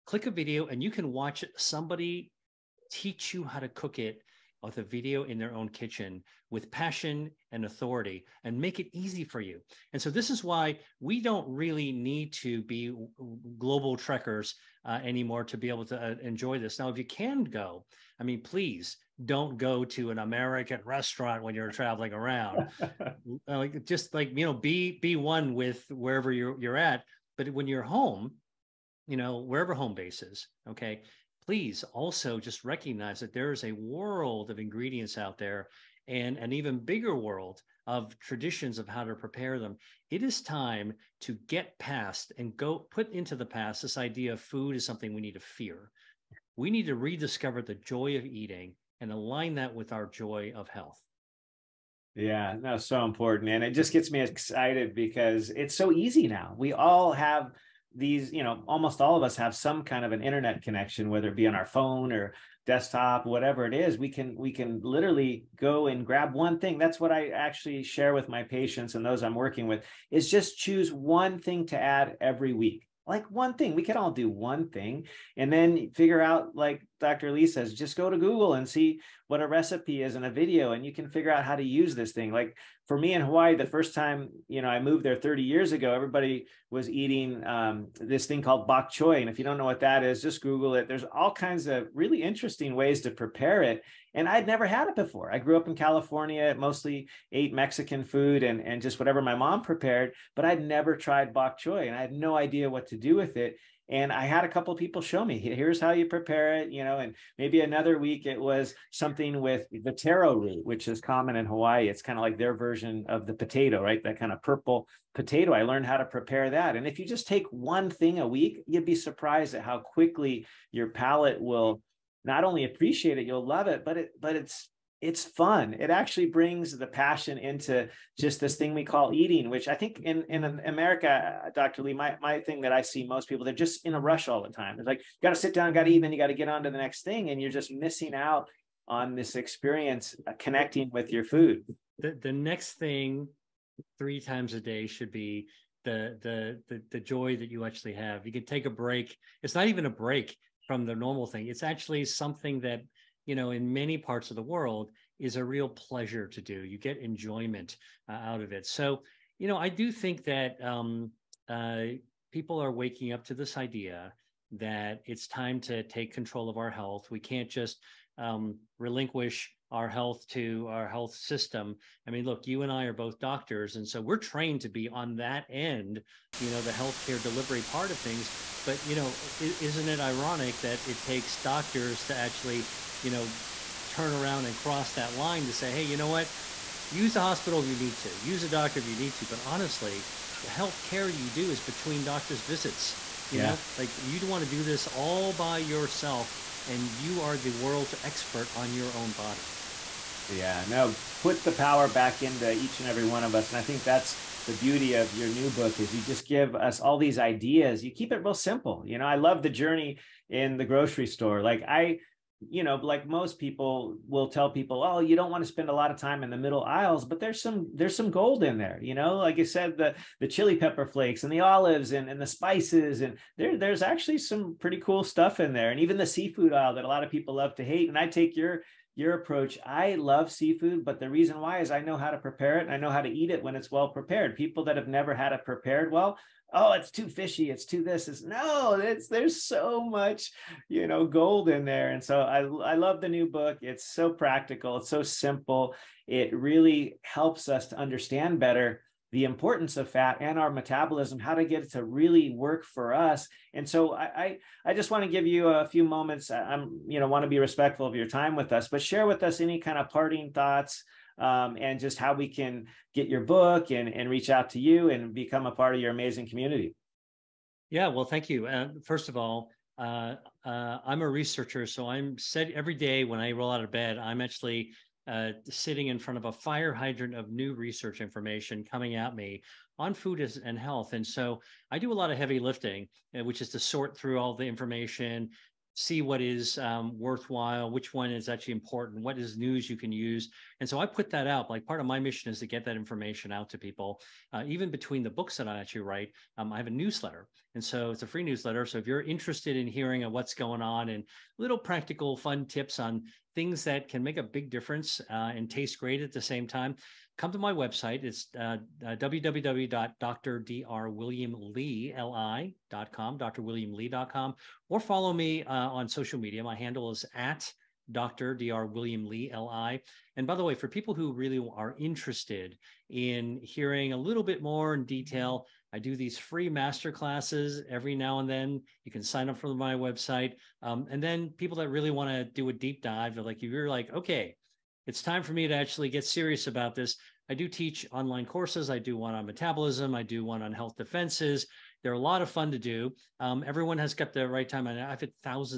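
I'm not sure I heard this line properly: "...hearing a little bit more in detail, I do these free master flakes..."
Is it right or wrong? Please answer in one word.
wrong.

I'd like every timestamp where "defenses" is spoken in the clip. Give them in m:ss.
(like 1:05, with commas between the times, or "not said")
5:40.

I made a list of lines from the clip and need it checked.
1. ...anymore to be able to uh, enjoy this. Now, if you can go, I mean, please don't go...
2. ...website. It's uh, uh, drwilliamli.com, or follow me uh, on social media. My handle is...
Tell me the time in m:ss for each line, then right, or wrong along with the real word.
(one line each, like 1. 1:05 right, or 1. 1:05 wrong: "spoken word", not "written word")
1. 0:15 right
2. 5:07 right.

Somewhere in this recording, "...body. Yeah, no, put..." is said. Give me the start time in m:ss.
3:19.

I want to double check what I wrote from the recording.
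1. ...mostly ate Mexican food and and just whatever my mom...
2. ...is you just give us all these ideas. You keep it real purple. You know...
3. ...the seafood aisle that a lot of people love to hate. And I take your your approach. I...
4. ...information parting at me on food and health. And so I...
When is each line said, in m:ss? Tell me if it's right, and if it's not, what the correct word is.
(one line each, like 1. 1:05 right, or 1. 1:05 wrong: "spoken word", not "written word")
1. 1:36 right
2. 3:25 wrong: "simple", not "purple"
3. 3:45 right
4. 4:38 wrong: "coming", not "parting".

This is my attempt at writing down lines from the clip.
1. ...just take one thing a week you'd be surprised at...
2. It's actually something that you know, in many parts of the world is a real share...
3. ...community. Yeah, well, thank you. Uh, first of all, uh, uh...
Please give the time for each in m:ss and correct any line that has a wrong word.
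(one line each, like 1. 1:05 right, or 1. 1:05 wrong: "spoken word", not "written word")
1. 1:57 right
2. 2:31 wrong: "pleasure", not "share"
3. 4:26 right.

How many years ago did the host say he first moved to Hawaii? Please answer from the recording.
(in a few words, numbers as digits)
30.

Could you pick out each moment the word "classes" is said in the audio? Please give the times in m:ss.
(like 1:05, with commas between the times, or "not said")
5:26.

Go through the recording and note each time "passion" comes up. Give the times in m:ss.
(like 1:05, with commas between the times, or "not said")
0:06, 2:06.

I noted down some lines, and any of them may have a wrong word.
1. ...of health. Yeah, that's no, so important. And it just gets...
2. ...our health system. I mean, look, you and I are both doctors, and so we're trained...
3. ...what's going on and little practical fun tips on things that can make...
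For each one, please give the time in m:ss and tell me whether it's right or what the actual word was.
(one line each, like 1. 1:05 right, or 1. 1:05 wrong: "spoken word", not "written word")
1. 0:50 right
2. 2:50 right
3. 5:00 right.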